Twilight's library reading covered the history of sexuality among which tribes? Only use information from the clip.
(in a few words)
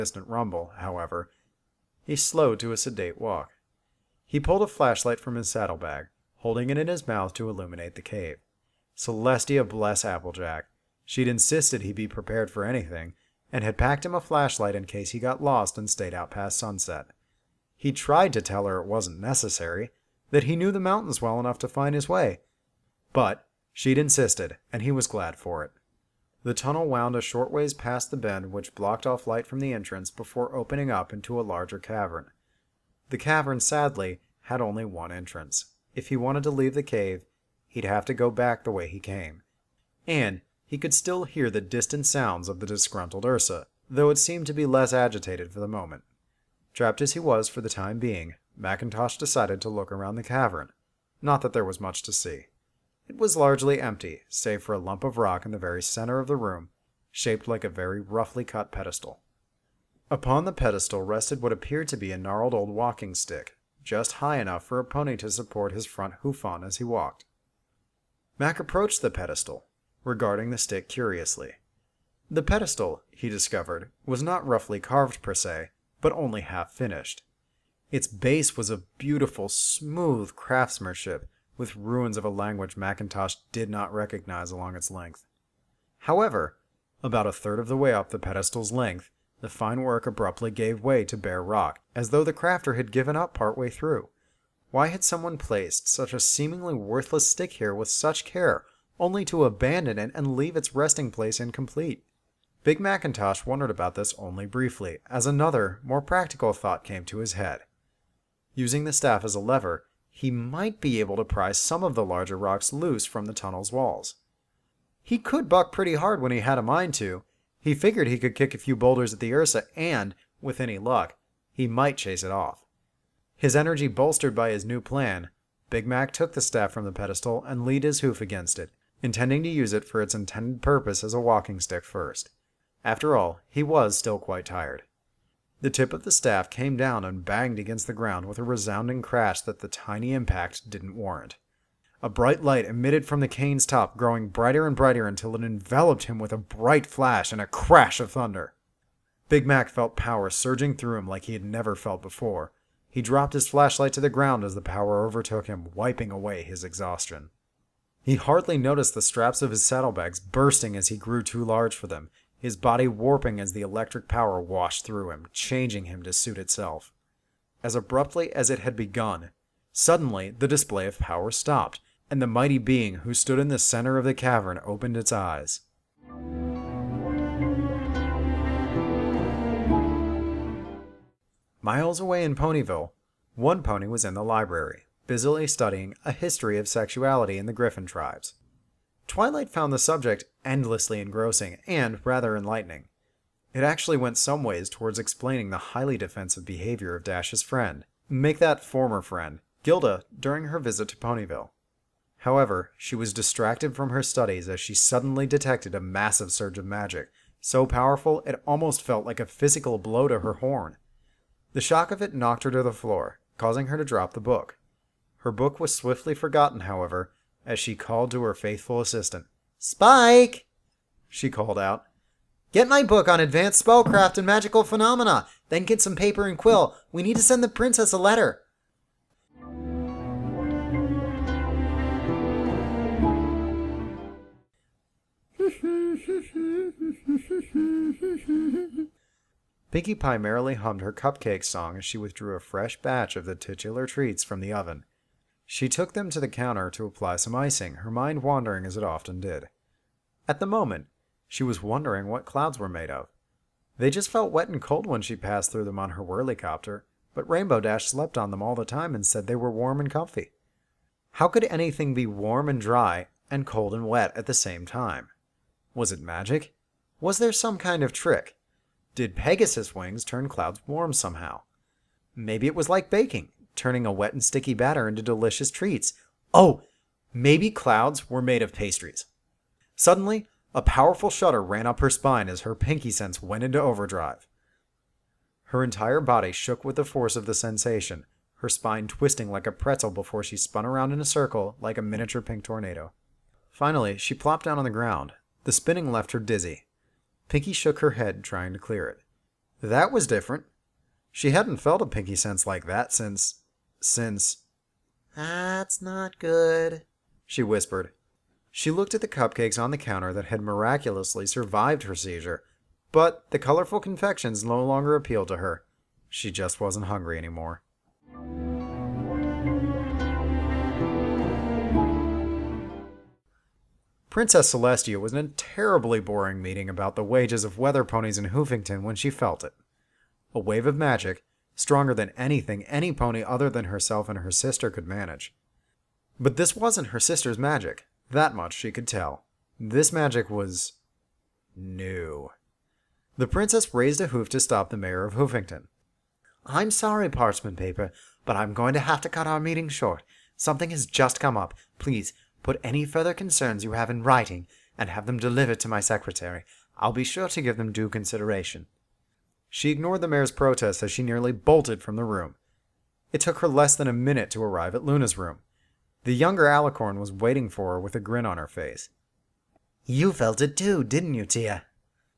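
Griffin tribes.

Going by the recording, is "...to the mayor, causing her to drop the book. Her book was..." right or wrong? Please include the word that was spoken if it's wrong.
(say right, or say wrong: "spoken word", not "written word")
wrong: "floor", not "mayor".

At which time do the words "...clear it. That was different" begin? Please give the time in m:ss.
4:58.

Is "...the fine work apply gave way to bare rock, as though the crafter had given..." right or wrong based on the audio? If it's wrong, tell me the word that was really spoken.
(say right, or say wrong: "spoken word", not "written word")
wrong: "abruptly", not "apply".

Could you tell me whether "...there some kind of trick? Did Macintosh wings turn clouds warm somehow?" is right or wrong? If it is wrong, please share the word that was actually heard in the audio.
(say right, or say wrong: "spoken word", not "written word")
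wrong: "Pegasus", not "Macintosh".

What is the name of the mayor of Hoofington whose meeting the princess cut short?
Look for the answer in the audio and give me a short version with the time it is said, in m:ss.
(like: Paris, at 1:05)
Parchment Paper, at 5:47.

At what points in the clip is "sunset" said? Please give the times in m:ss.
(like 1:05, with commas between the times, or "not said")
0:16.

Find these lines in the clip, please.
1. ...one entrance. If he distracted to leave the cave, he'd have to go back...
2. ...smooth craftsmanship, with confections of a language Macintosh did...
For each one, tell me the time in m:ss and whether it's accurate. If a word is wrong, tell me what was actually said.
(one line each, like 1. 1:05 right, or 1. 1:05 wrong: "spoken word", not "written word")
1. 0:34 wrong: "wanted", not "distracted"
2. 1:19 wrong: "ruins", not "confections".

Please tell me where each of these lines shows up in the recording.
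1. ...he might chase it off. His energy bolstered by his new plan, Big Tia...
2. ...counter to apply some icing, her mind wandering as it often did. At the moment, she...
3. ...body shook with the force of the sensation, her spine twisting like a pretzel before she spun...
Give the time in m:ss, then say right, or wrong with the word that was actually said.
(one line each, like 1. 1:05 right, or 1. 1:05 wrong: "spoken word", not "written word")
1. 2:01 wrong: "Mac", not "Tia"
2. 4:06 right
3. 4:46 right.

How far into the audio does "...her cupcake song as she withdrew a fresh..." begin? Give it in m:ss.
4:00.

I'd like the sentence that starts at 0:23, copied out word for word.
But she'd insisted, and he was glad for it.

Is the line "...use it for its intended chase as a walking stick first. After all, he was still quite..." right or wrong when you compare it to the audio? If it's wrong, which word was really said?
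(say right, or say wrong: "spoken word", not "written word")
wrong: "purpose", not "chase".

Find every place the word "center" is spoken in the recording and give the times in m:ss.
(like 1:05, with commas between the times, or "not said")
0:55, 2:53.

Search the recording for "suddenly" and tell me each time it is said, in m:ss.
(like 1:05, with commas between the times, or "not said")
2:49, 3:24, 4:39.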